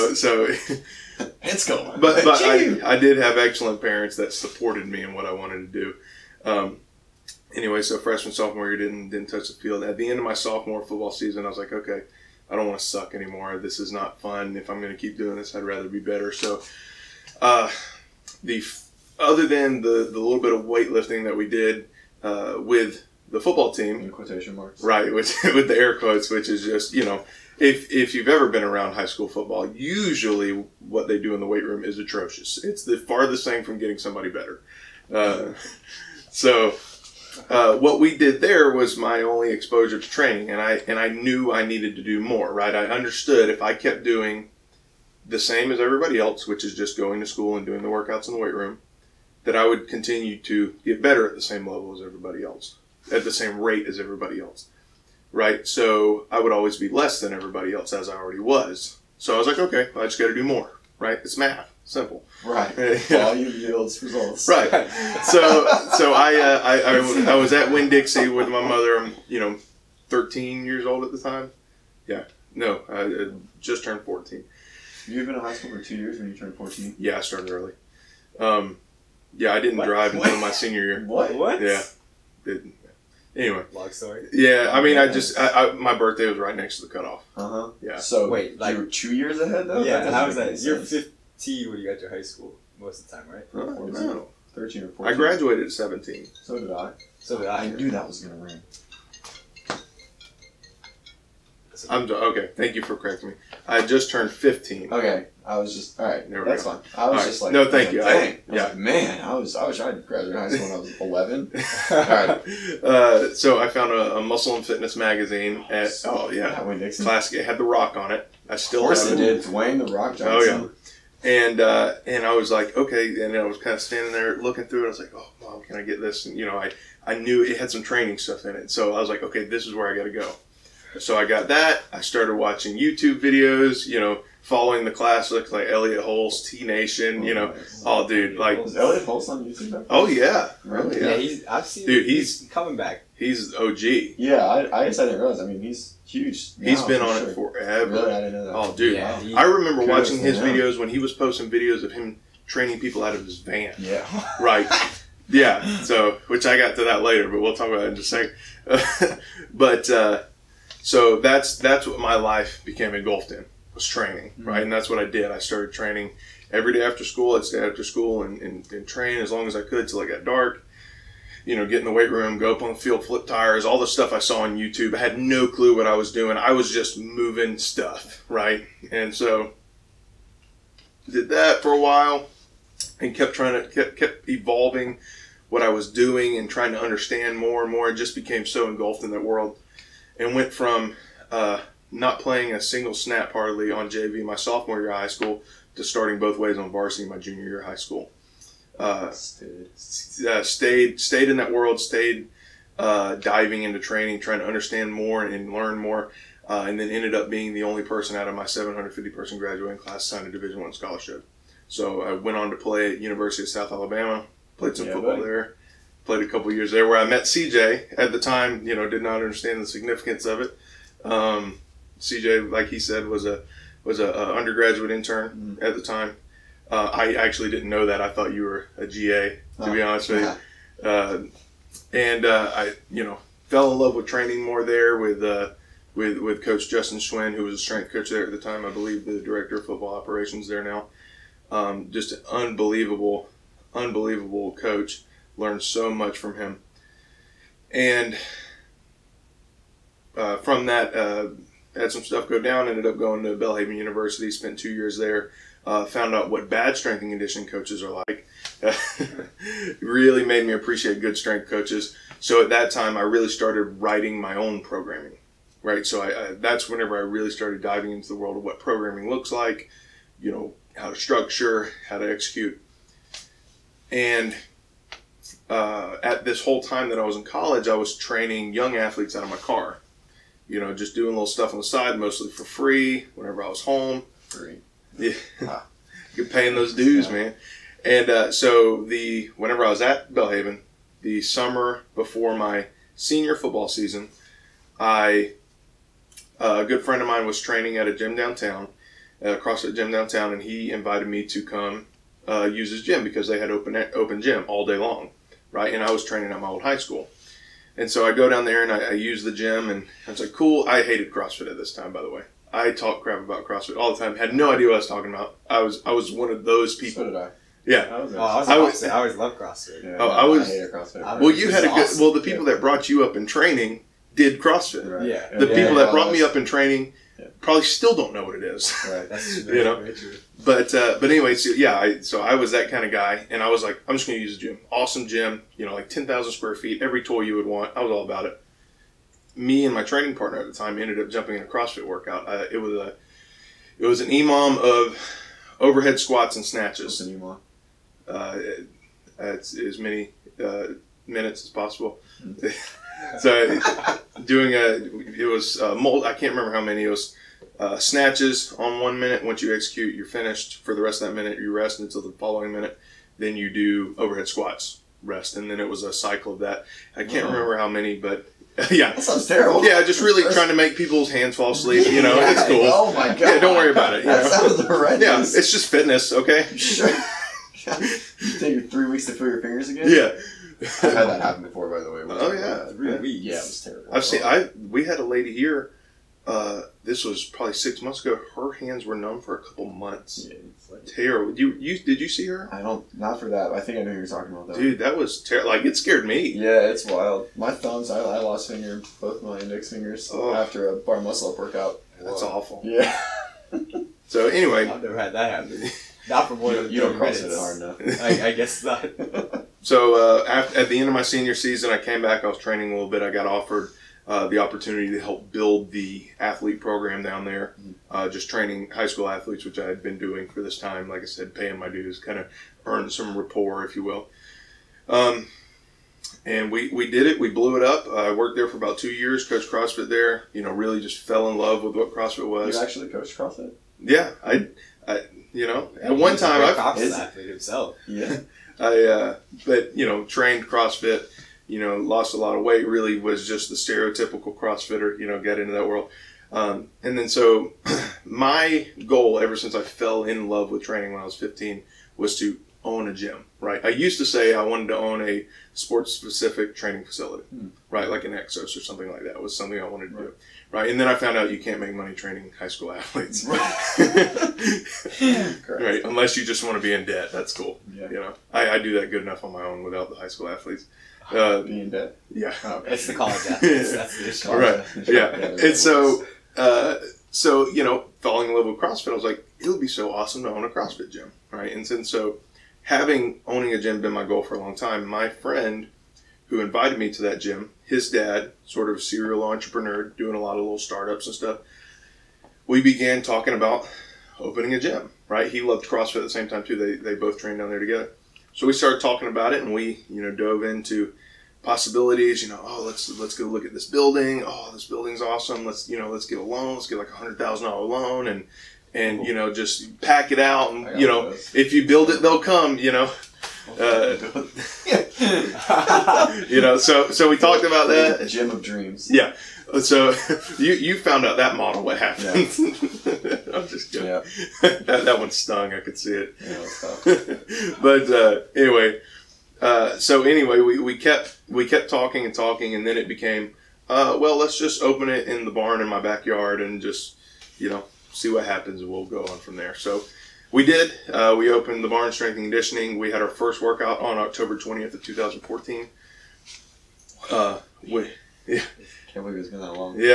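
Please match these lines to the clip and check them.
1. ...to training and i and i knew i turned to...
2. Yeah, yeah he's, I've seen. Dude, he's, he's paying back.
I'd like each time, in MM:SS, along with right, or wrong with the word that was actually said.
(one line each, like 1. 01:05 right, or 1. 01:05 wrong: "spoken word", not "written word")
1. 00:39 wrong: "needed", not "turned"
2. 02:20 wrong: "coming", not "paying".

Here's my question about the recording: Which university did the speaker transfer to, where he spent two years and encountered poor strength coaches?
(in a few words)
Belhaven University.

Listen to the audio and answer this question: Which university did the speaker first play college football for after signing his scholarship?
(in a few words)
University of South Alabama.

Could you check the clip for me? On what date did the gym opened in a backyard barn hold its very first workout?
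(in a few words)
October 20, 2014.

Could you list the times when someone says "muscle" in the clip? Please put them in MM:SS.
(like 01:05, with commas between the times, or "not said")
01:54, 06:40.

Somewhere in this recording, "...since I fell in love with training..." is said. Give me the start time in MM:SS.
07:29.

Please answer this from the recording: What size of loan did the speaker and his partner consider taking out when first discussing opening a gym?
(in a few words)
$100,000.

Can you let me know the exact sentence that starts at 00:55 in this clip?
So I would always be less than everybody else as I already was.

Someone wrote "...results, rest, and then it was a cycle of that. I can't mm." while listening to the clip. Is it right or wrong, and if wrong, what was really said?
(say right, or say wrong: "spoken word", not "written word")
wrong: "squats", not "results".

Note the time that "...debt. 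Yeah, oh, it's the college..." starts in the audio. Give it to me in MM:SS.
07:51.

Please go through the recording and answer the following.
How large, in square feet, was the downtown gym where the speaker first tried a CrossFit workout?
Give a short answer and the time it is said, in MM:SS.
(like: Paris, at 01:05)
10,000 square feet, at 05:35.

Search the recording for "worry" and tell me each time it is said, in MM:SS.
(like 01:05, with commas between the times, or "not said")
06:13.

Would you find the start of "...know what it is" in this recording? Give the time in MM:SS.
05:28.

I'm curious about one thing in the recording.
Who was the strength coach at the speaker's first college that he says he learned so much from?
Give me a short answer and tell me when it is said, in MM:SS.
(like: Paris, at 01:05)
Justin Schwinn, at 03:56.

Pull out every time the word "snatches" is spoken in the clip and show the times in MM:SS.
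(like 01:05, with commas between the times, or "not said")
05:46, 05:57.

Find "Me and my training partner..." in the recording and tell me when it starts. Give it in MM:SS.
05:39.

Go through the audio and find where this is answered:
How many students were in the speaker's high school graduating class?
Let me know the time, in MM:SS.
03:28.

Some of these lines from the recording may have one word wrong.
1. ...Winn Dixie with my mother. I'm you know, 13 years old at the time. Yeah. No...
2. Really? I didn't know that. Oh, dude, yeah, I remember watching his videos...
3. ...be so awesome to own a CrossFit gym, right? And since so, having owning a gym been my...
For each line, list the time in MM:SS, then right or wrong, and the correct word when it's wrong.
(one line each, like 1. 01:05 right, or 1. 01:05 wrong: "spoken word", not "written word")
1. 01:07 right
2. 02:27 right
3. 07:59 right.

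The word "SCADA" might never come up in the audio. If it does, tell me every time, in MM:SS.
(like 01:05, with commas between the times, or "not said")
not said.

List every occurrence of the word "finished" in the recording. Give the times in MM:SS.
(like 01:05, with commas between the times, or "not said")
06:00.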